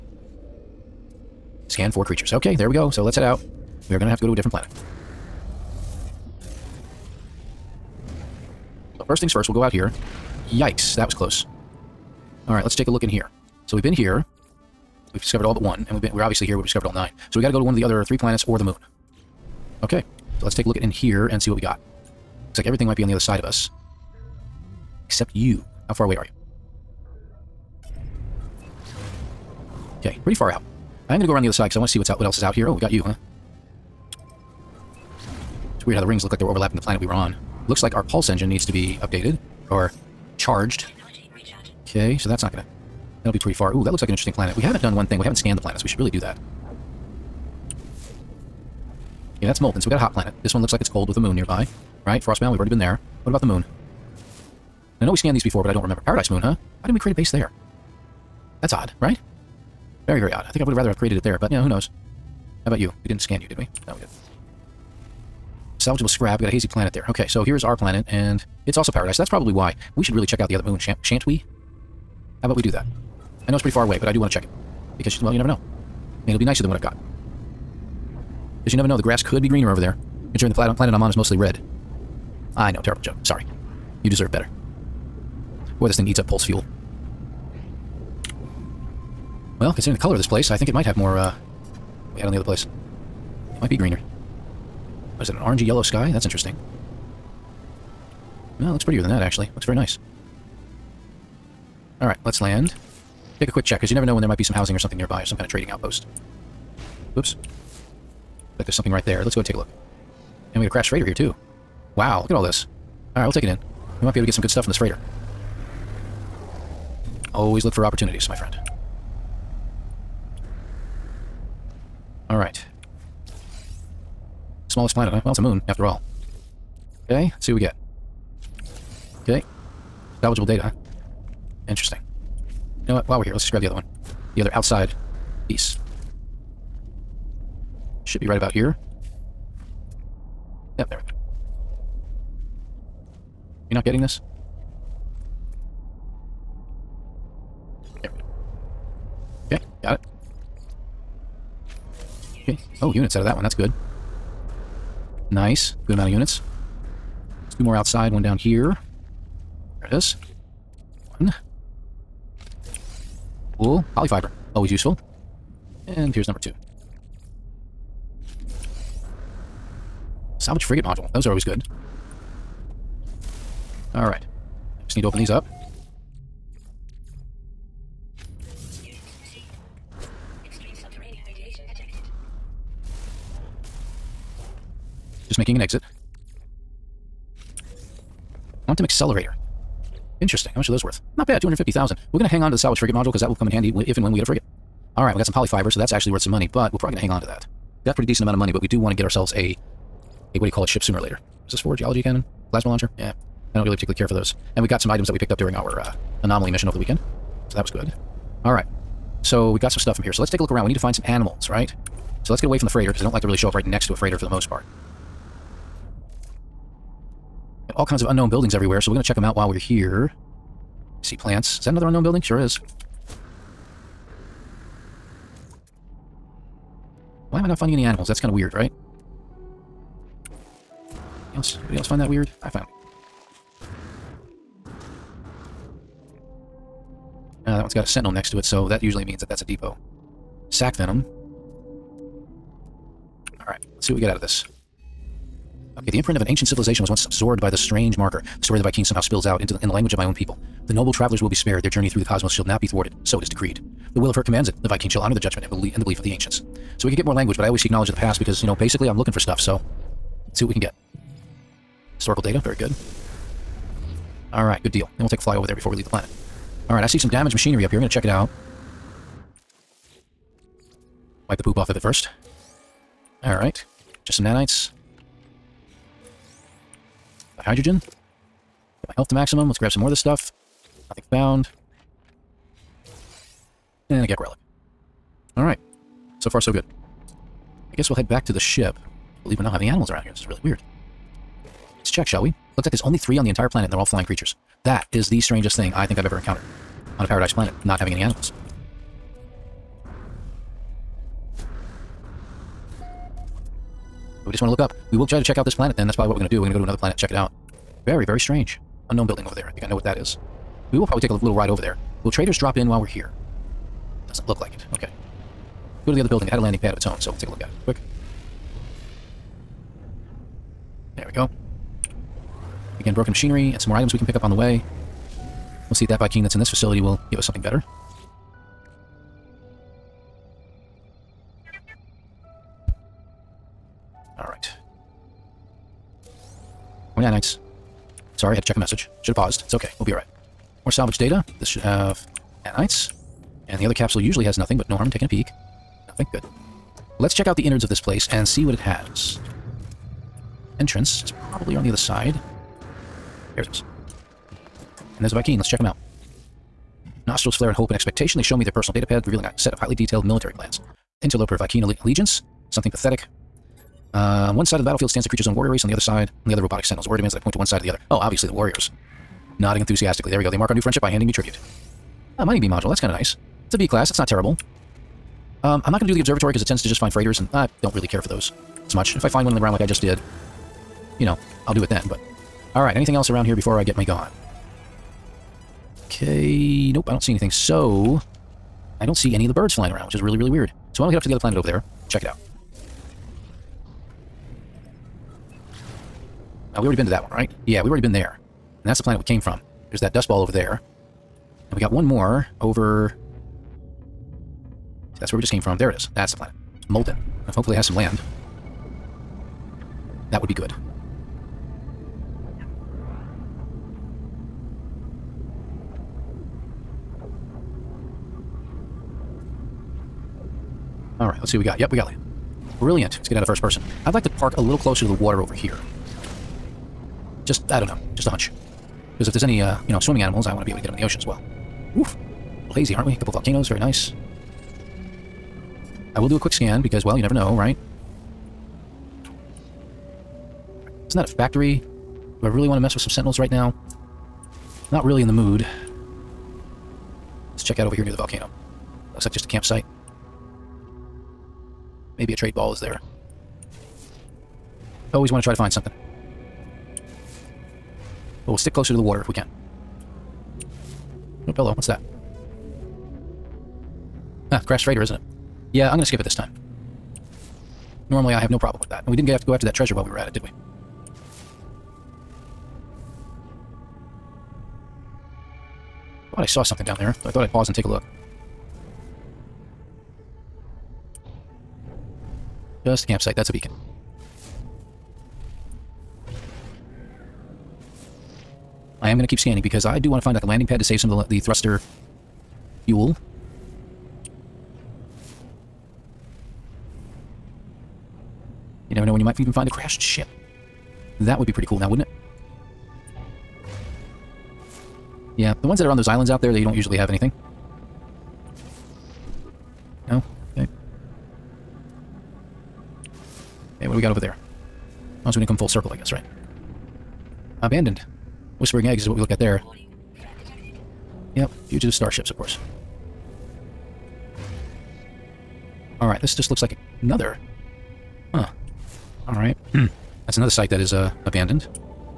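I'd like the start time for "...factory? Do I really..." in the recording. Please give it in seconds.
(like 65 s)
441 s.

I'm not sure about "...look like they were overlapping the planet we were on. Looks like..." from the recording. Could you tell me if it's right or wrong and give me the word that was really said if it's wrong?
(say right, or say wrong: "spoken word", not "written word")
right.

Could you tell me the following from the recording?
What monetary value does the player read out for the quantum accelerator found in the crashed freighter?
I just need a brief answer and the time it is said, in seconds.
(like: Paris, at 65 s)
250,000, at 191 s.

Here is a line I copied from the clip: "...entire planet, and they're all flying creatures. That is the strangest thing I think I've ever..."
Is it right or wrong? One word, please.
right.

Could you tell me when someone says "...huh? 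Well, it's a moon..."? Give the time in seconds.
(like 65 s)
125 s.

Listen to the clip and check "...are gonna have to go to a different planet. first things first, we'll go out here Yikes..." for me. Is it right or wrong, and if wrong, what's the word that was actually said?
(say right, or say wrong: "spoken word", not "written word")
right.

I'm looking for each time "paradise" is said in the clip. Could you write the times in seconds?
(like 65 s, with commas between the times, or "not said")
56 s, 68 s, 297 s.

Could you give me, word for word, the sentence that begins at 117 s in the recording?
Always look for opportunities, my friend.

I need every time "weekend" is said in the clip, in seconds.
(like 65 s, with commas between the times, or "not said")
206 s.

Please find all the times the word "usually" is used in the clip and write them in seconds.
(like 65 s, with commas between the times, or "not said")
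238 s, 344 s, 506 s.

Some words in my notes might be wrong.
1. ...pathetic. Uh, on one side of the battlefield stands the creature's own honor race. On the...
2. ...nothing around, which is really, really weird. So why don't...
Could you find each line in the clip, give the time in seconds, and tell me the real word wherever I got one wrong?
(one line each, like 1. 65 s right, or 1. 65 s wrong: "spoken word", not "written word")
1. 362 s wrong: "warrior", not "honor"
2. 389 s wrong: "flying", not "nothing".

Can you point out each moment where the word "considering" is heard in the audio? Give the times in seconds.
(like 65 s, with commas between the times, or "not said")
80 s, 89 s.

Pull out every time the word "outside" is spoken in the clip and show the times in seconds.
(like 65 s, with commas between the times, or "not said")
134 s, 157 s.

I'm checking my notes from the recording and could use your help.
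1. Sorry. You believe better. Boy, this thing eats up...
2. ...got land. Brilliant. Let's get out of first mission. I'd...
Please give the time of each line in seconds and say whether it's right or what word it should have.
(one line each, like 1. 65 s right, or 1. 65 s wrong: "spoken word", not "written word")
1. 83 s wrong: "deserve", not "believe"
2. 421 s wrong: "person", not "mission".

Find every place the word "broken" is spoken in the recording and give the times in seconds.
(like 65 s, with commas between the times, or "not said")
322 s.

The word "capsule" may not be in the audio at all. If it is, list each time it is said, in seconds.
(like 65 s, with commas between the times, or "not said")
343 s.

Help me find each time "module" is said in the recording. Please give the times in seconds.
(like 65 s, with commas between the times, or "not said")
170 s, 192 s, 372 s.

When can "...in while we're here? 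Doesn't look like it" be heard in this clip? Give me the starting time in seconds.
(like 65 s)
312 s.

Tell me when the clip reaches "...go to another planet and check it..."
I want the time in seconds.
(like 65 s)
306 s.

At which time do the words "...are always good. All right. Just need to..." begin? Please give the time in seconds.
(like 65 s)
171 s.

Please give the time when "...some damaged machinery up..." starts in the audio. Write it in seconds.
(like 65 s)
266 s.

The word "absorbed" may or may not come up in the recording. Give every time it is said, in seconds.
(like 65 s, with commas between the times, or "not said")
247 s.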